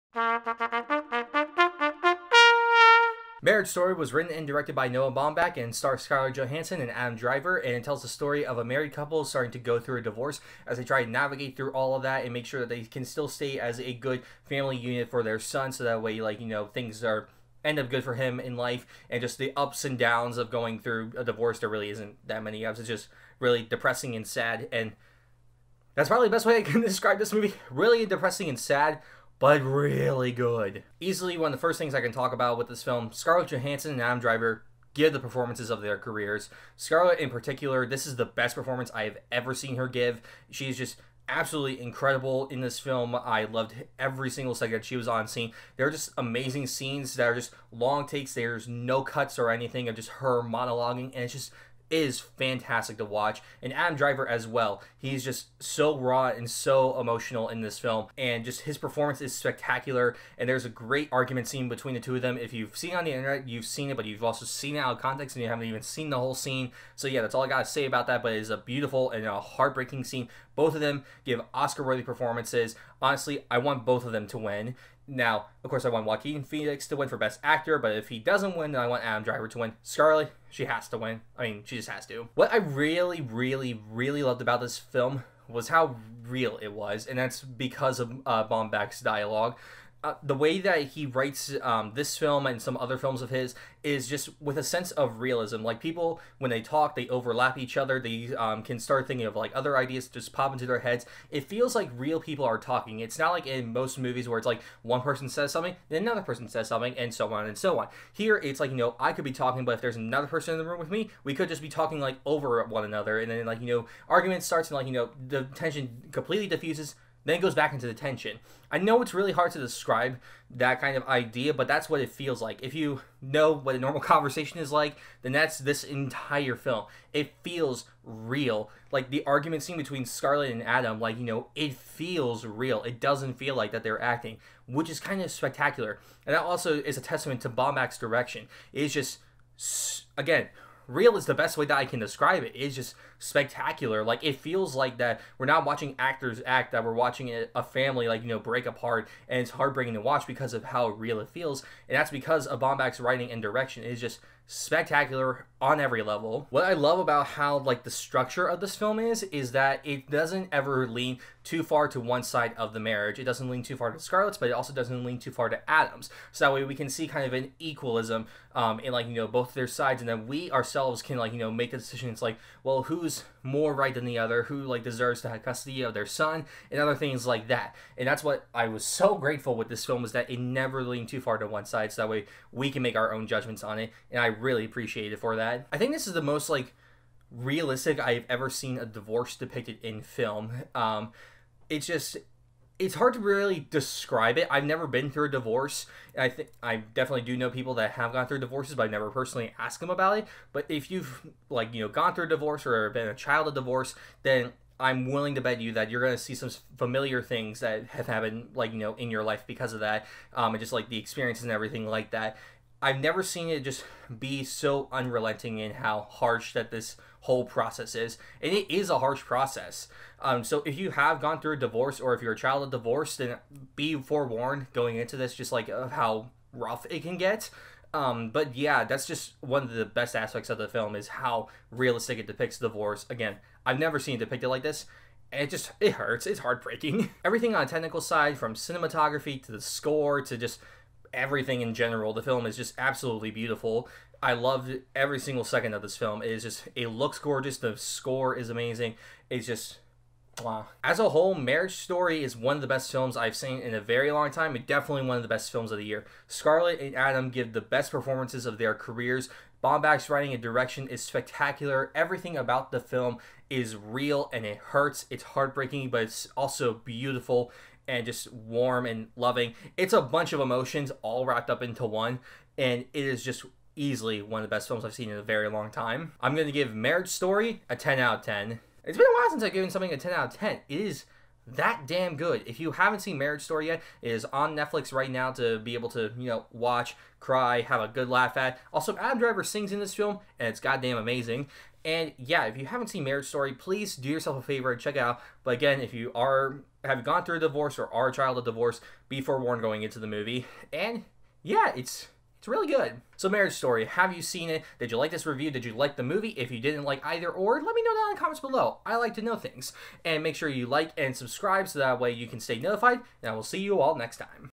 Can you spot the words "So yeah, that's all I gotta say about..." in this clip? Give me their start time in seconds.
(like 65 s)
66 s.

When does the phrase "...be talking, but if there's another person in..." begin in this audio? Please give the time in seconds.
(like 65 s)
109 s.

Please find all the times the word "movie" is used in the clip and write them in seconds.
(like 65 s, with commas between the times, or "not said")
27 s, 103 s, 300 s, 306 s.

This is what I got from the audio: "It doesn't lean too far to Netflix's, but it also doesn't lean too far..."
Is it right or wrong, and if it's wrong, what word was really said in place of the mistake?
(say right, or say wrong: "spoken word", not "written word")
wrong: "Scarlett", not "Netflix".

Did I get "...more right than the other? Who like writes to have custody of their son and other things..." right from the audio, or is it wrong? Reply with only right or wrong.
wrong.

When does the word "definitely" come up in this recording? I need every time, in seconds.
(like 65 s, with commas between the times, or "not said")
196 s, 254 s.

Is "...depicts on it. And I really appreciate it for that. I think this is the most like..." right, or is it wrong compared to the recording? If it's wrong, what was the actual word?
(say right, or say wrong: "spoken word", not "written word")
wrong: "judgments", not "depicts".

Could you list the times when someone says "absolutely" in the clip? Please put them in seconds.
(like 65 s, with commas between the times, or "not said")
41 s, 242 s.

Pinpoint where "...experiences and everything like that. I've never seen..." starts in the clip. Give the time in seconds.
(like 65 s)
210 s.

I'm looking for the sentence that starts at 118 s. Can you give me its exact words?
I know it's really hard to describe that kind of idea, but that's what it feels like.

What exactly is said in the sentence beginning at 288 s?
Also, Adam Driver sings in this film, and it's goddamn amazing.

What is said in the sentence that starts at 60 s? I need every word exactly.
And there's a great argument scene between the two of them.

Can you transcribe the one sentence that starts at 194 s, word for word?
I've never been through a divorce.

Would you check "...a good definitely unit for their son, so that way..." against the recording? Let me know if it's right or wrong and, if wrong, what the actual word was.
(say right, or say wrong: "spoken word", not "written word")
wrong: "family", not "definitely".